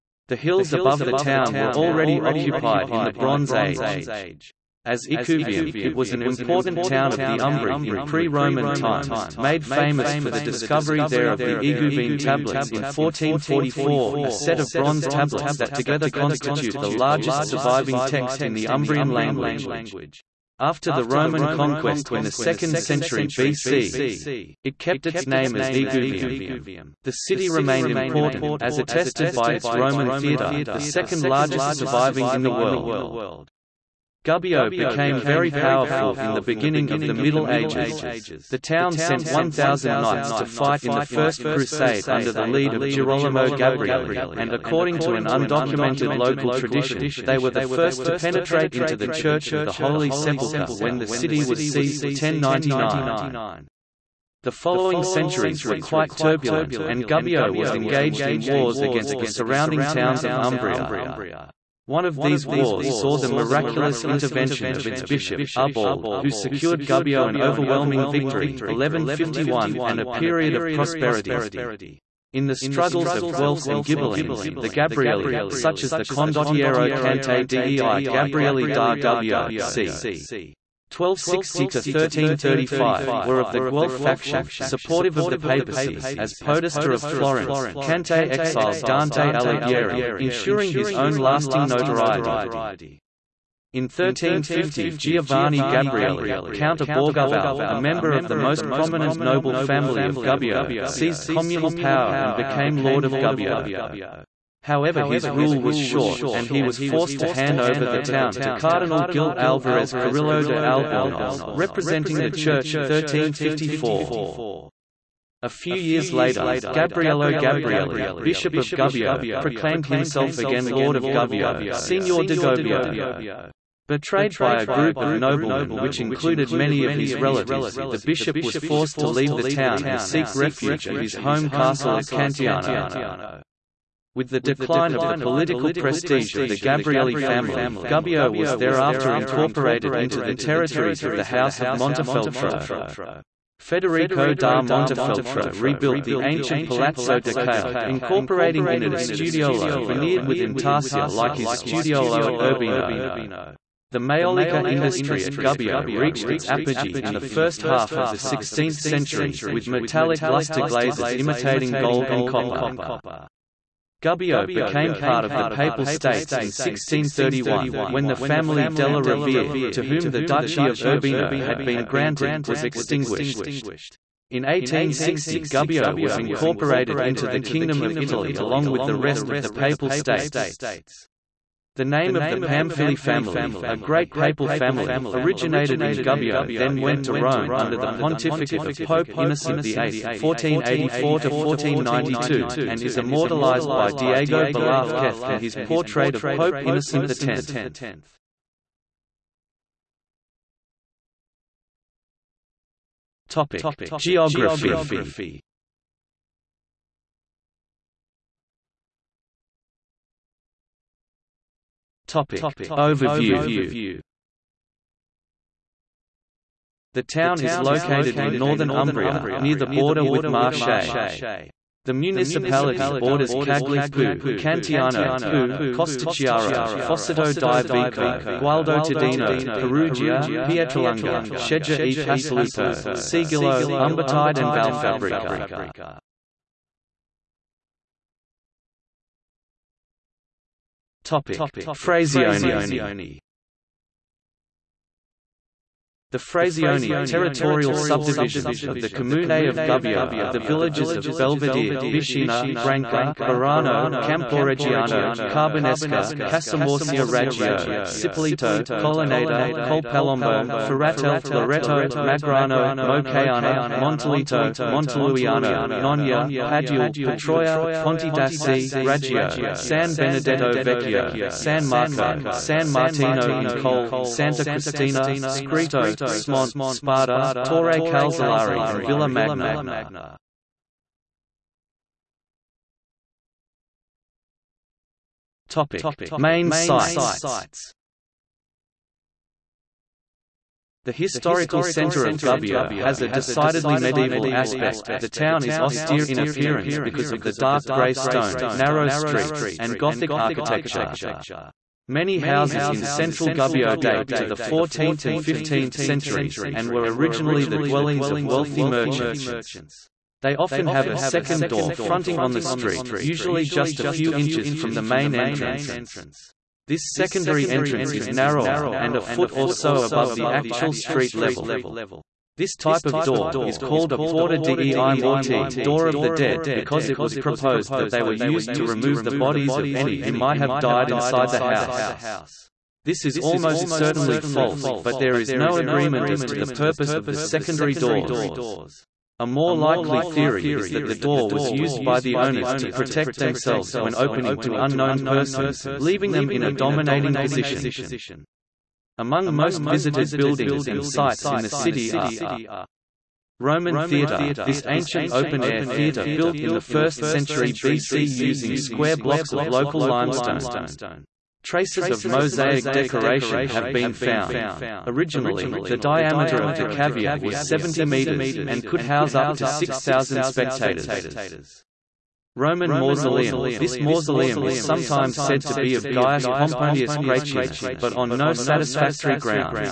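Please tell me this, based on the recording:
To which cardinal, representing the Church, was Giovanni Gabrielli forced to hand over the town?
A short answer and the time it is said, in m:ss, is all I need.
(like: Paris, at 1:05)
Gil Alvarez Carrillo de Albornoz, at 1:49.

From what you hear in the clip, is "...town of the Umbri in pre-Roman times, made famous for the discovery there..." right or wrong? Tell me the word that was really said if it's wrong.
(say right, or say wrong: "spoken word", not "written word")
right.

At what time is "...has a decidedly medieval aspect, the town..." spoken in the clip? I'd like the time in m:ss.
4:52.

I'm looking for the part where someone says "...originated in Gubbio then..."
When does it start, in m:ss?
3:05.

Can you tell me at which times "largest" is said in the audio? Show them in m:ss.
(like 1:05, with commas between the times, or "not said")
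0:16, 0:31.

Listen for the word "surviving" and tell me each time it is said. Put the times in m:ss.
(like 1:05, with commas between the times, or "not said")
0:17, 0:31.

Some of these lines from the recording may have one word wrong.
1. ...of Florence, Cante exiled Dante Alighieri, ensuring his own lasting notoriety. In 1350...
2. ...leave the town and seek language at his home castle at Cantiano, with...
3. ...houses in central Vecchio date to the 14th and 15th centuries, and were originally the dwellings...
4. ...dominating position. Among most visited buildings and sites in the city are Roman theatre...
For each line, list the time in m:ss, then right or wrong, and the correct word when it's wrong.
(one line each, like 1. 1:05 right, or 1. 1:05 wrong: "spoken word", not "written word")
1. 1:26 right
2. 2:09 wrong: "refuge", not "language"
3. 5:02 wrong: "Gubbio", not "Vecchio"
4. 5:46 right.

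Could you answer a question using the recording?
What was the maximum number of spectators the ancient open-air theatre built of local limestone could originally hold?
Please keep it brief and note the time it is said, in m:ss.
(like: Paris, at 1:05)
6,000, at 6:09.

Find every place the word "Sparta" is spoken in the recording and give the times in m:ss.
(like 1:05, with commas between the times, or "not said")
4:36.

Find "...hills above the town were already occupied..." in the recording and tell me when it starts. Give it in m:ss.
0:00.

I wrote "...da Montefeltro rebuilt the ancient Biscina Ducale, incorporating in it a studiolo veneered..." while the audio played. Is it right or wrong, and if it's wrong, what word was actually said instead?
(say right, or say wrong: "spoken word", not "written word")
wrong: "Palazzo", not "Biscina".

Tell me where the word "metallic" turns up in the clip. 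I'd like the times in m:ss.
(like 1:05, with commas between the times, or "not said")
2:39.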